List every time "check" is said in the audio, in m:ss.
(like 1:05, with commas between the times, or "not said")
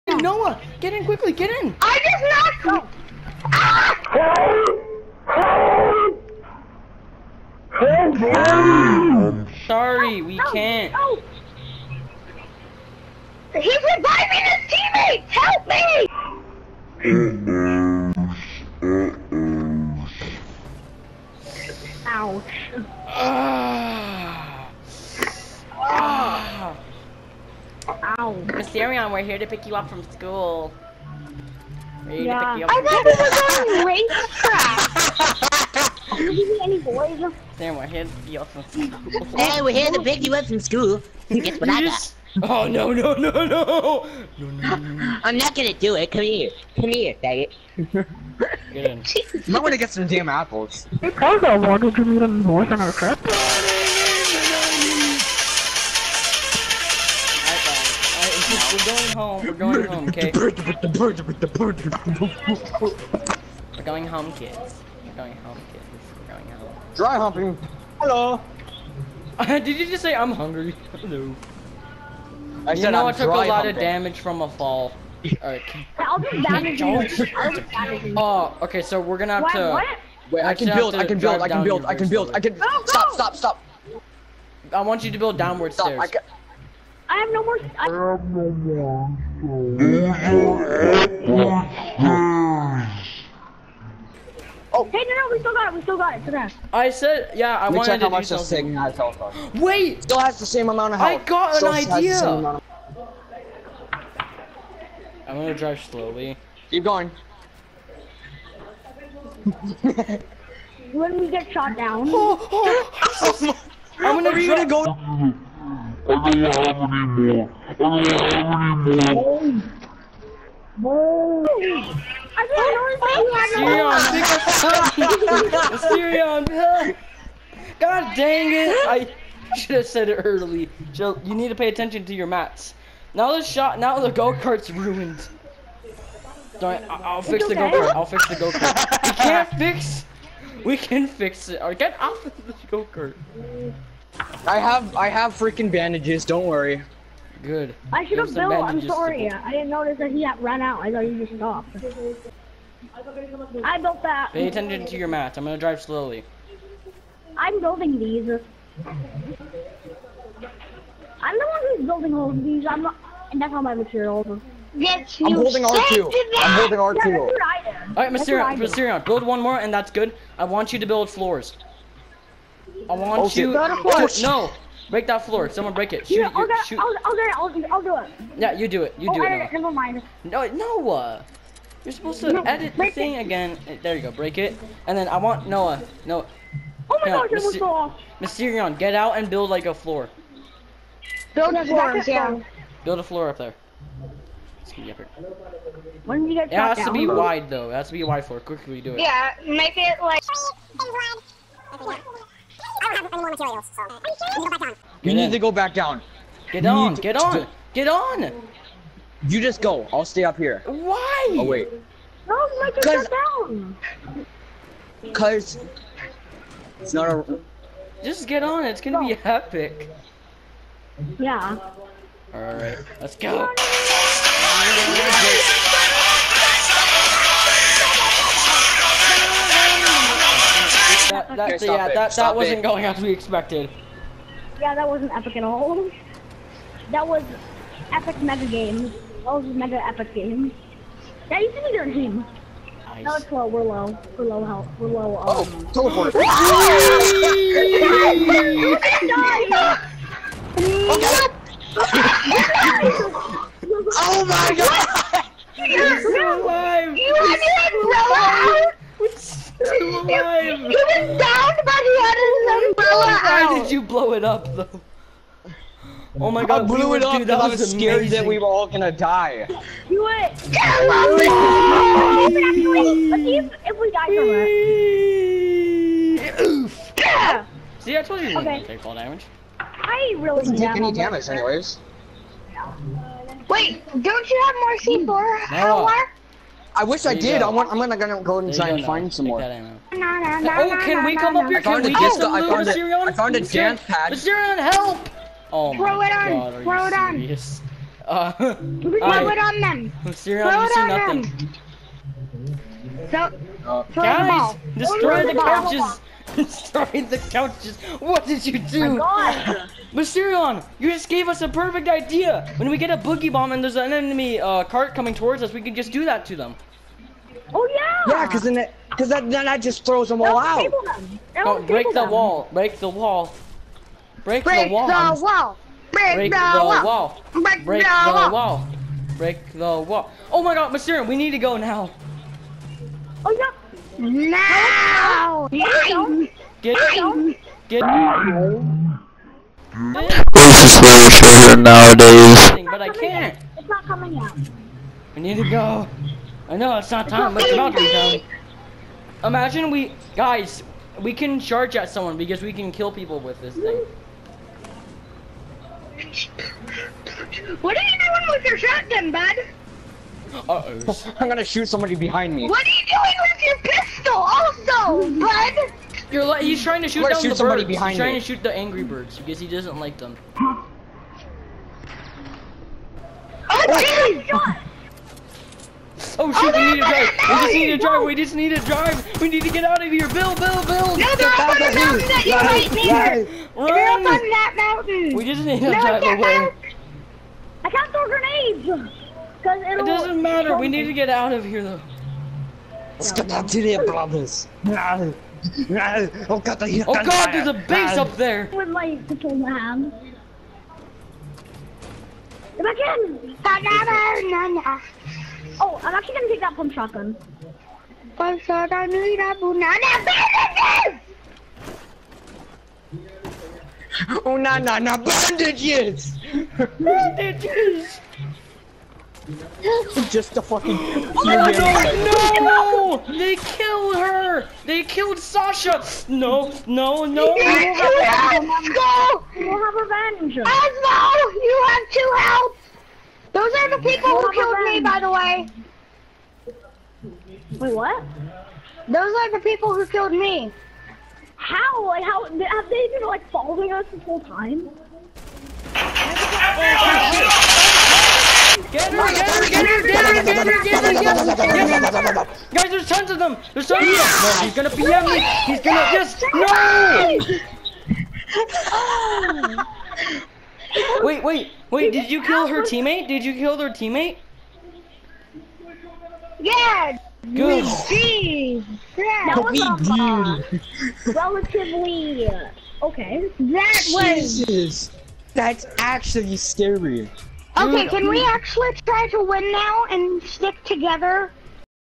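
1:37.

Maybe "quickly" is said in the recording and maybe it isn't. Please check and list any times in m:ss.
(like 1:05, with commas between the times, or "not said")
0:01, 3:18.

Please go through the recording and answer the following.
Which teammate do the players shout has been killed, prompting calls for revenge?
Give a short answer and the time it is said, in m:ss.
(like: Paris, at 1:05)
Sasha, at 7:04.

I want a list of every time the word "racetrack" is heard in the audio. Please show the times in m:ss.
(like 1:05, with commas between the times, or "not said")
0:36.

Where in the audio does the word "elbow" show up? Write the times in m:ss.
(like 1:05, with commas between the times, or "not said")
not said.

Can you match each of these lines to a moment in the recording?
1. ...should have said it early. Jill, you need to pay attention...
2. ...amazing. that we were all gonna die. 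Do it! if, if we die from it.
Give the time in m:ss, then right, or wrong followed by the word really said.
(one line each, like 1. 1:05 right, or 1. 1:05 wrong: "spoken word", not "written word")
1. 2:09 right
2. 4:27 right.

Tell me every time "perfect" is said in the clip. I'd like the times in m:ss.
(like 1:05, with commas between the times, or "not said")
5:11.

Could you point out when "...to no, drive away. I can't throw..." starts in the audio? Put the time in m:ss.
6:25.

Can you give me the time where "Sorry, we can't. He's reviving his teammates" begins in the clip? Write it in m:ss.
0:09.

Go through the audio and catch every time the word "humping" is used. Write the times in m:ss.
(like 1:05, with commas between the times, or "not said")
1:07, 1:13.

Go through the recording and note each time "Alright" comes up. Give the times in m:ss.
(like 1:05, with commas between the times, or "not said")
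1:15, 2:47.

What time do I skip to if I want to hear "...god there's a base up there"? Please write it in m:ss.
6:37.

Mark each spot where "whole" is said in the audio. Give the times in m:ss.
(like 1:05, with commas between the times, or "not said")
7:24.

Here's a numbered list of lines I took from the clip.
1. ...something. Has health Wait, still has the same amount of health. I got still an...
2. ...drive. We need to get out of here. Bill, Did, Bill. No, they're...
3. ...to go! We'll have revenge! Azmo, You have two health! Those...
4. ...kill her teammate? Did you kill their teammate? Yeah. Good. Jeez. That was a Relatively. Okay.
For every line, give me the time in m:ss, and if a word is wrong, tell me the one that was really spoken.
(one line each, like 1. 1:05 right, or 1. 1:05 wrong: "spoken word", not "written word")
1. 1:38 right
2. 6:18 wrong: "Bill", not "Did"
3. 7:08 right
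4. 7:42 right.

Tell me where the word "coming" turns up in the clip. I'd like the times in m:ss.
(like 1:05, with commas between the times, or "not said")
5:14, 5:43.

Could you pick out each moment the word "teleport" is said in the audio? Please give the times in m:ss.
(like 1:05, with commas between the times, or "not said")
4:05.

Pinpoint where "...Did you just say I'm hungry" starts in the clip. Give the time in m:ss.
1:09.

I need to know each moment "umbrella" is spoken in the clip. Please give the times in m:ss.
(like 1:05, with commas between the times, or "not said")
4:17, 4:22.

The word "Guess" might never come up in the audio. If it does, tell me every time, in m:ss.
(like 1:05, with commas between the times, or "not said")
0:41.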